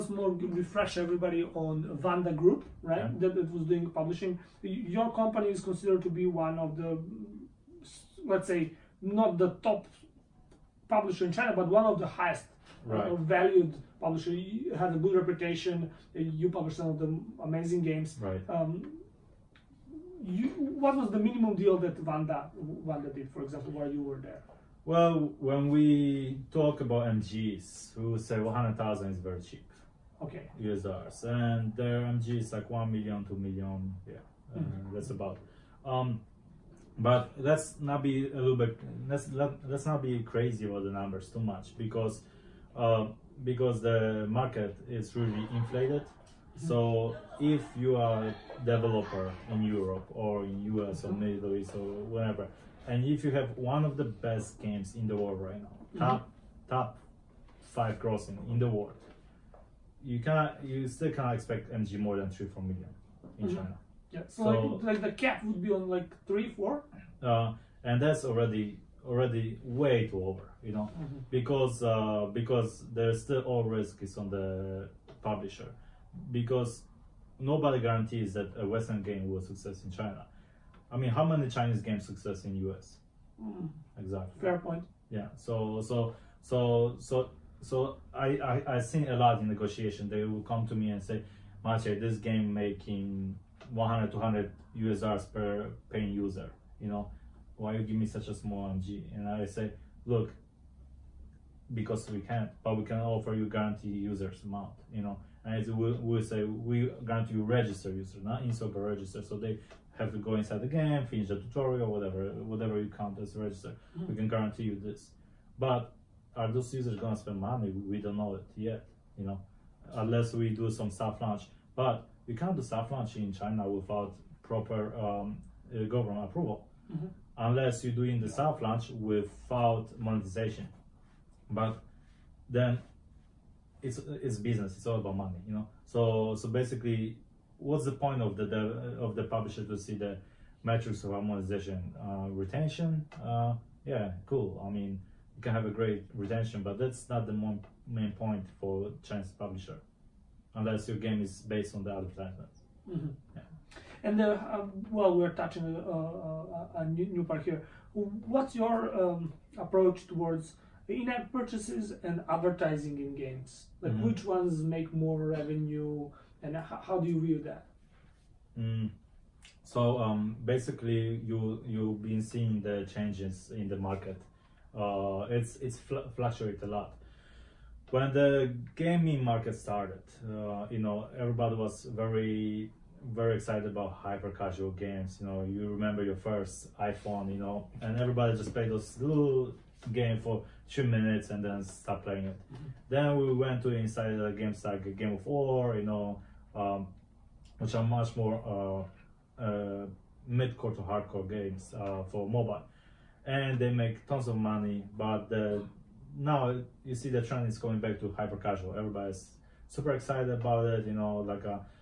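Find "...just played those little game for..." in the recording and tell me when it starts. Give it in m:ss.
3:08.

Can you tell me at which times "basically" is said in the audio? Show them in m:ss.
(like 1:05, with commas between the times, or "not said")
2:16, 2:50.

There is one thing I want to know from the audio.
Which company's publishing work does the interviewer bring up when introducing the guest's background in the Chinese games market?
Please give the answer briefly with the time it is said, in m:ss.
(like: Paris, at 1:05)
Wanda Group, at 0:02.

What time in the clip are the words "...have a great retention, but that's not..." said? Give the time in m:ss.
2:25.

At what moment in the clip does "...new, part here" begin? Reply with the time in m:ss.
2:37.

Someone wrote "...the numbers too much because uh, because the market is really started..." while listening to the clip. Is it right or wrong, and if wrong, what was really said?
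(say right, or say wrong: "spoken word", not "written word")
wrong: "inflated", not "started".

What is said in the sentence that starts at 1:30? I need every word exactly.
They will come to me and say, Maciej, this game making 100 200 us dollars per paying user.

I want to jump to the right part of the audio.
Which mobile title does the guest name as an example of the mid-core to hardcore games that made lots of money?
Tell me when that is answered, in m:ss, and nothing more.
3:14.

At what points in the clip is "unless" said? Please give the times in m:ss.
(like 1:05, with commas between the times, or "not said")
2:00, 2:07, 2:30.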